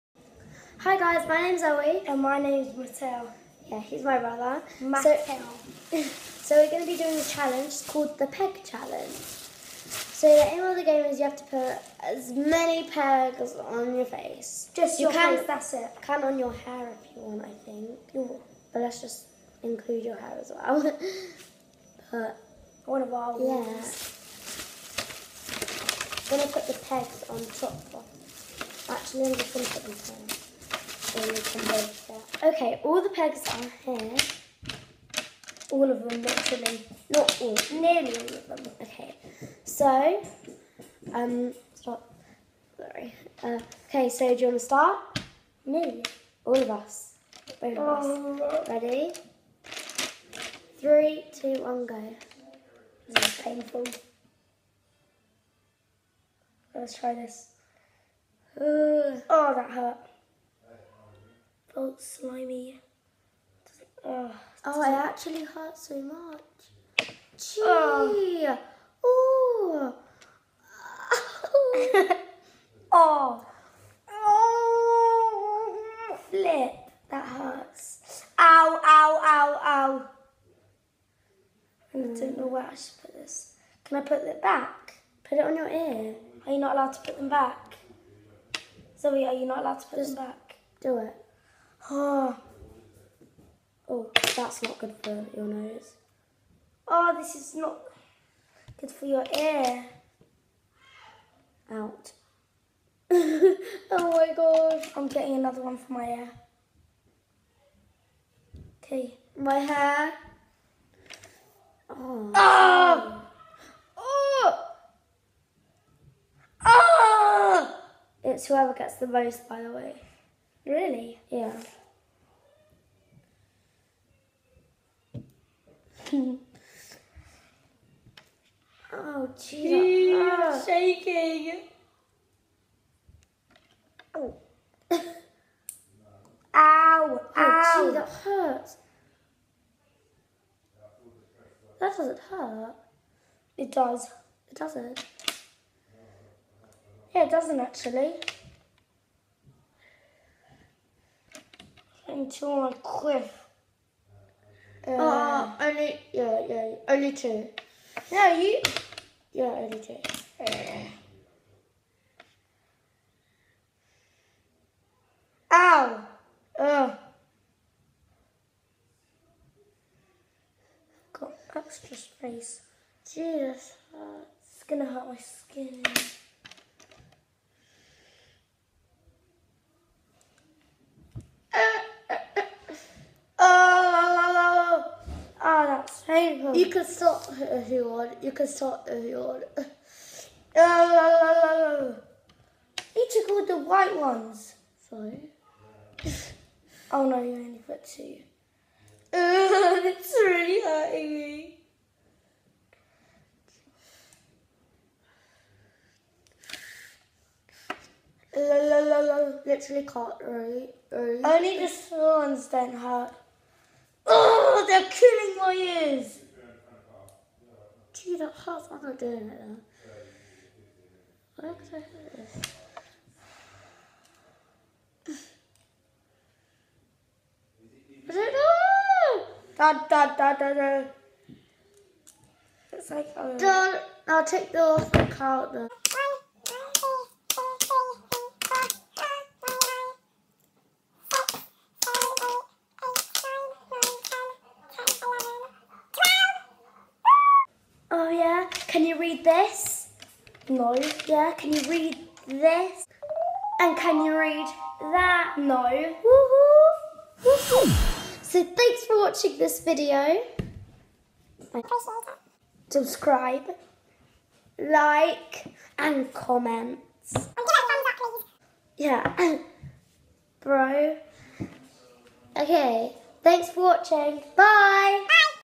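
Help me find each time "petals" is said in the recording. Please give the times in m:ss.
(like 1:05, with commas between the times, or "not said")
not said.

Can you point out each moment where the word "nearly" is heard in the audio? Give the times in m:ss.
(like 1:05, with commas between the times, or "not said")
0:37.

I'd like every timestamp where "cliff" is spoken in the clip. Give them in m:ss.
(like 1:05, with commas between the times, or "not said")
2:32.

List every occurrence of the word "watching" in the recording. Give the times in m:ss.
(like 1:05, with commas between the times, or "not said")
4:18, 4:33.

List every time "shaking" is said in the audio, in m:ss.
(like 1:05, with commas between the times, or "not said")
2:10.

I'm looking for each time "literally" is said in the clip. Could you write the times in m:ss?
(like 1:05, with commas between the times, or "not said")
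0:36, 3:29.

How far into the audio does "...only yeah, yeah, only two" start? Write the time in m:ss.
2:35.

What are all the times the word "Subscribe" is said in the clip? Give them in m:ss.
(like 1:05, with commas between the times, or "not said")
4:22.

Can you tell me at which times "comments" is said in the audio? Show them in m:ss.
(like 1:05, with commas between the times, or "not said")
4:26.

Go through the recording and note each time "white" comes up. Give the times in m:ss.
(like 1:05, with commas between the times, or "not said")
3:13.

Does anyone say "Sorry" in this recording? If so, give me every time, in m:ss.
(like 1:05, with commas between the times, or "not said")
0:42, 3:14.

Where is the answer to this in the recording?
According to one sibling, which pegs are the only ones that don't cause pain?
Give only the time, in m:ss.
3:31.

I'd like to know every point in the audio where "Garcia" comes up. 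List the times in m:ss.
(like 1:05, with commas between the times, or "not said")
not said.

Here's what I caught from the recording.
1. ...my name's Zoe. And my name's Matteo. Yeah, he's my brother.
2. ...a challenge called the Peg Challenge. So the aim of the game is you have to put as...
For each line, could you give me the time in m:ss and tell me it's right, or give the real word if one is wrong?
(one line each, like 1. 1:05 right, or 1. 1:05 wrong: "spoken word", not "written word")
1. 0:01 right
2. 0:07 right.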